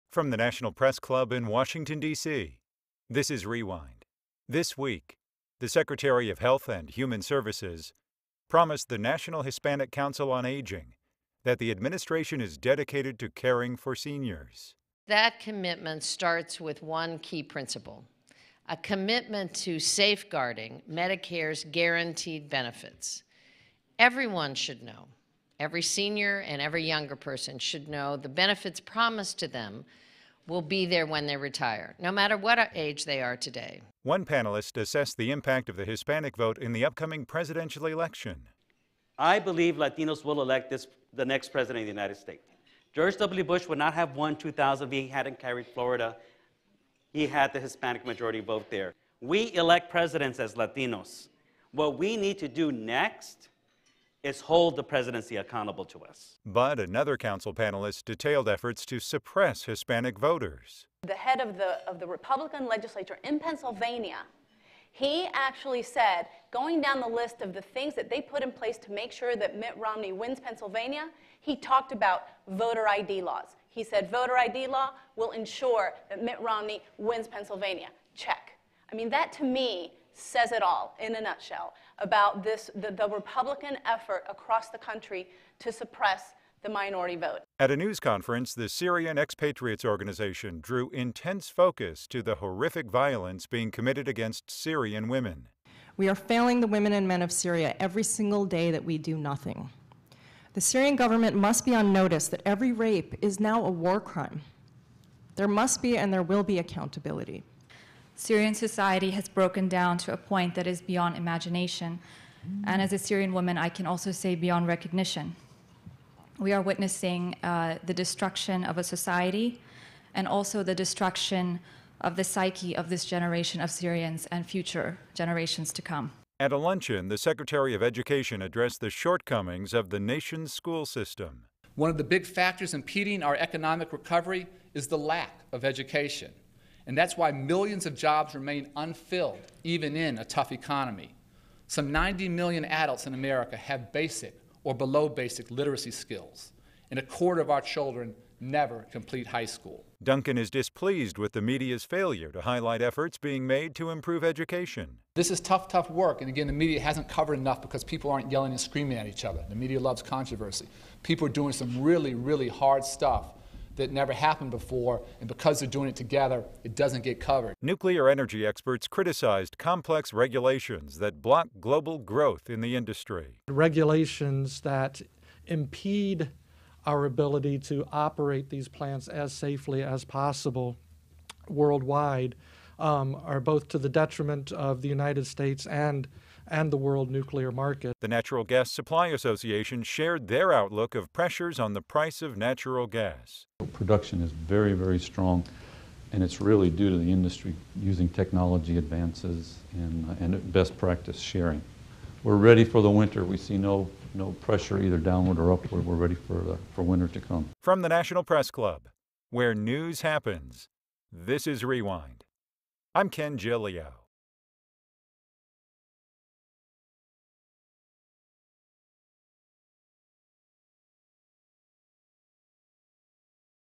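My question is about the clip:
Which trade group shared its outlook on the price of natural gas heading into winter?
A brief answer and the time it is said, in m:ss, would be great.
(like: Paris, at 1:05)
Natural Gas Supply Association, at 3:08.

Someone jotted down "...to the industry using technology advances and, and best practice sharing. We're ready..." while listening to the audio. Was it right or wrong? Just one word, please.
right.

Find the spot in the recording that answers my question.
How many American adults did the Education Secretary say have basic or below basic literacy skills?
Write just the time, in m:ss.
2:21.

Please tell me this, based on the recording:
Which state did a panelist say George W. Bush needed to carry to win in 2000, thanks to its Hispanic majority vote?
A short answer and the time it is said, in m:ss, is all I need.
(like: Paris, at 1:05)
Florida, at 0:45.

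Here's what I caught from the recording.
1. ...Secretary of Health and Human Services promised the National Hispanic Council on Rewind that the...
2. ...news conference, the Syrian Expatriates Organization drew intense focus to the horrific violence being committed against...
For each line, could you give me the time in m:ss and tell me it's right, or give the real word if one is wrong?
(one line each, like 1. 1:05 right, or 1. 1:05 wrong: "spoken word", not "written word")
1. 0:05 wrong: "Aging", not "Rewind"
2. 1:27 right.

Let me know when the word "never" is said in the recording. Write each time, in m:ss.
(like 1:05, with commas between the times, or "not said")
2:28, 2:43.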